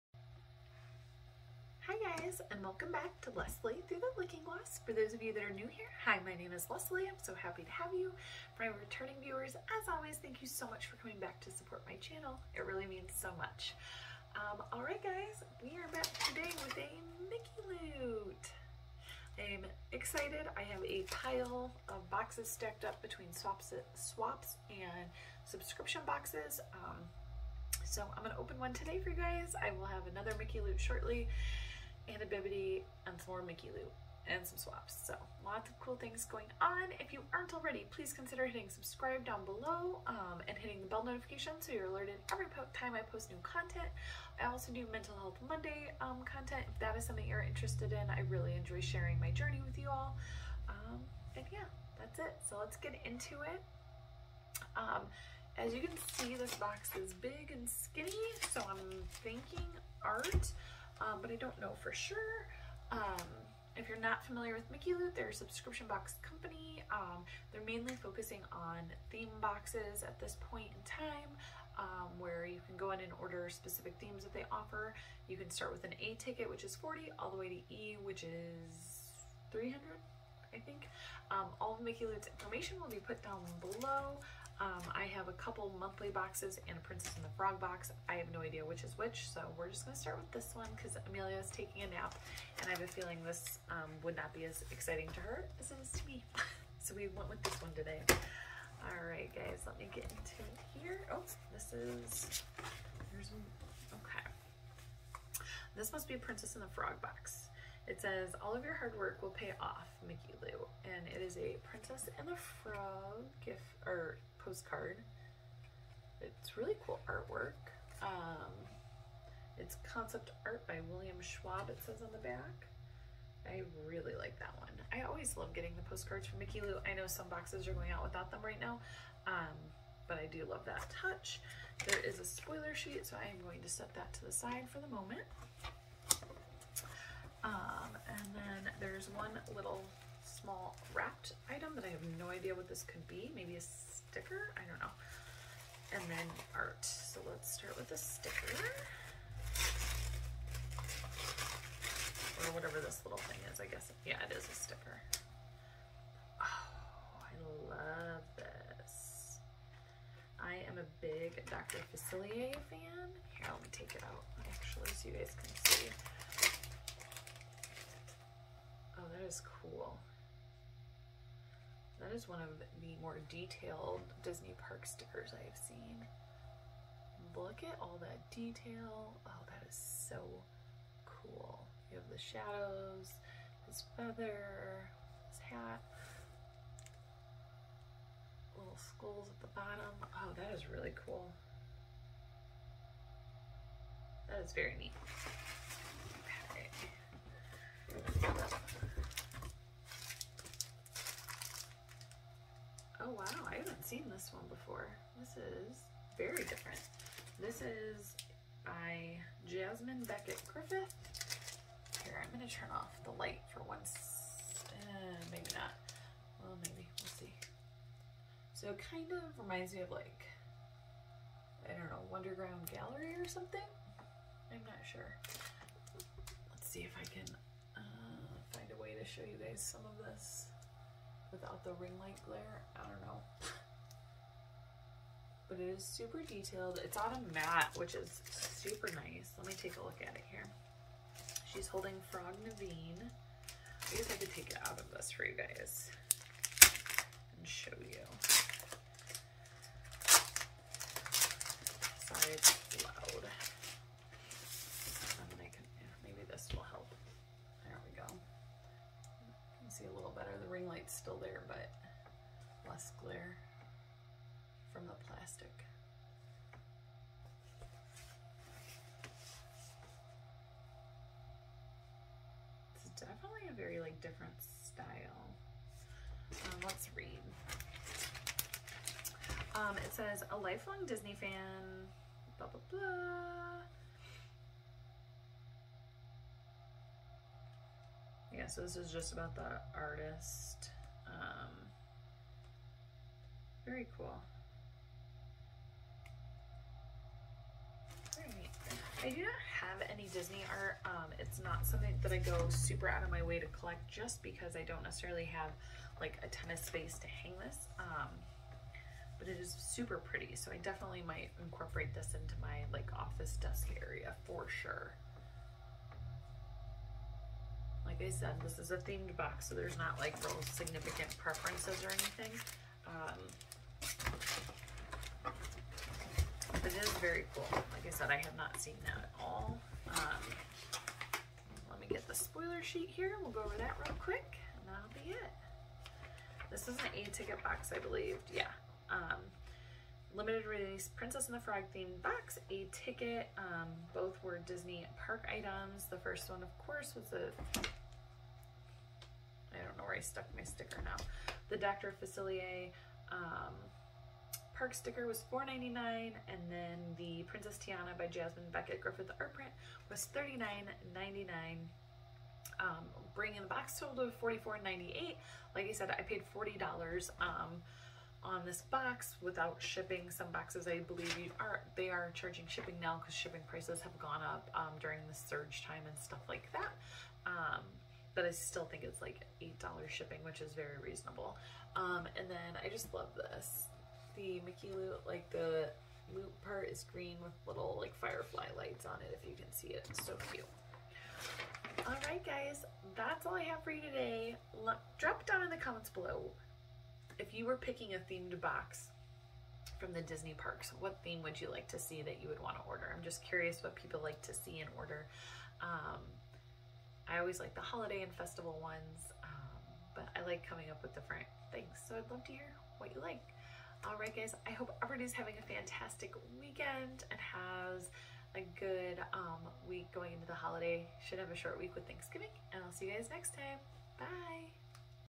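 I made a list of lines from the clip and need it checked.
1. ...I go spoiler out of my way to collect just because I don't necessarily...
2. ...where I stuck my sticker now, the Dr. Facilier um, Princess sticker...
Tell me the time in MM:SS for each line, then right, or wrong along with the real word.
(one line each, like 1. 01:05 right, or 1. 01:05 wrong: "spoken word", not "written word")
1. 05:02 wrong: "super", not "spoiler"
2. 05:49 wrong: "Park", not "Princess".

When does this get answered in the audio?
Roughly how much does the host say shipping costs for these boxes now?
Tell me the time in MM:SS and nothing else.
06:19.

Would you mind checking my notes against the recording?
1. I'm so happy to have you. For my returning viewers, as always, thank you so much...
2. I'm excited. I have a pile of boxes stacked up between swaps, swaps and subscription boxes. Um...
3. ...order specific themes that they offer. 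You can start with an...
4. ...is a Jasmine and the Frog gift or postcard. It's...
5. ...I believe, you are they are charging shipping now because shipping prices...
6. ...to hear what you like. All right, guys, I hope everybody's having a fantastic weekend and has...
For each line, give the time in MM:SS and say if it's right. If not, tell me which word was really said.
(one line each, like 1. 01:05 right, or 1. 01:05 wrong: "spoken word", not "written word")
1. 00:07 right
2. 00:19 right
3. 01:13 right
4. 01:51 wrong: "Princess", not "Jasmine"
5. 06:10 right
6. 06:52 right.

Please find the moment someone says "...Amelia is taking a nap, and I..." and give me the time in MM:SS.
01:31.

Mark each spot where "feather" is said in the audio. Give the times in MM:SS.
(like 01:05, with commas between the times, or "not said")
03:03.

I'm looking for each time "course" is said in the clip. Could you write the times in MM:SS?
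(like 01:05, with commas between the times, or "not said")
05:46.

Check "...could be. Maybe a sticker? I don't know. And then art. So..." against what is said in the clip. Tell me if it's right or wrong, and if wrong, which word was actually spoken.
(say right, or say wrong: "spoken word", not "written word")
right.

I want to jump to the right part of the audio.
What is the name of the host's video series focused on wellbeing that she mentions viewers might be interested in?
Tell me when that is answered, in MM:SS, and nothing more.
00:44.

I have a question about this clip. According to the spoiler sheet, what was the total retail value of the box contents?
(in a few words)
$44.98.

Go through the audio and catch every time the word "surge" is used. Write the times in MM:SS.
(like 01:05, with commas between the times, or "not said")
06:15.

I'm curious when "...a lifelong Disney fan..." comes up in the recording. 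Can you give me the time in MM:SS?
04:40.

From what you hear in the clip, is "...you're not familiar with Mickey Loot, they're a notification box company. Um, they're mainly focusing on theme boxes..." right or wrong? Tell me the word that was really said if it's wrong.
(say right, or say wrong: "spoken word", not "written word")
wrong: "subscription", not "notification".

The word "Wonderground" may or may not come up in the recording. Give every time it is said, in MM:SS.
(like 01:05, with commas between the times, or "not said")
03:42.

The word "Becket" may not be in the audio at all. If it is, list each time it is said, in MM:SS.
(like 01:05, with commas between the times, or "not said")
03:30, 05:58.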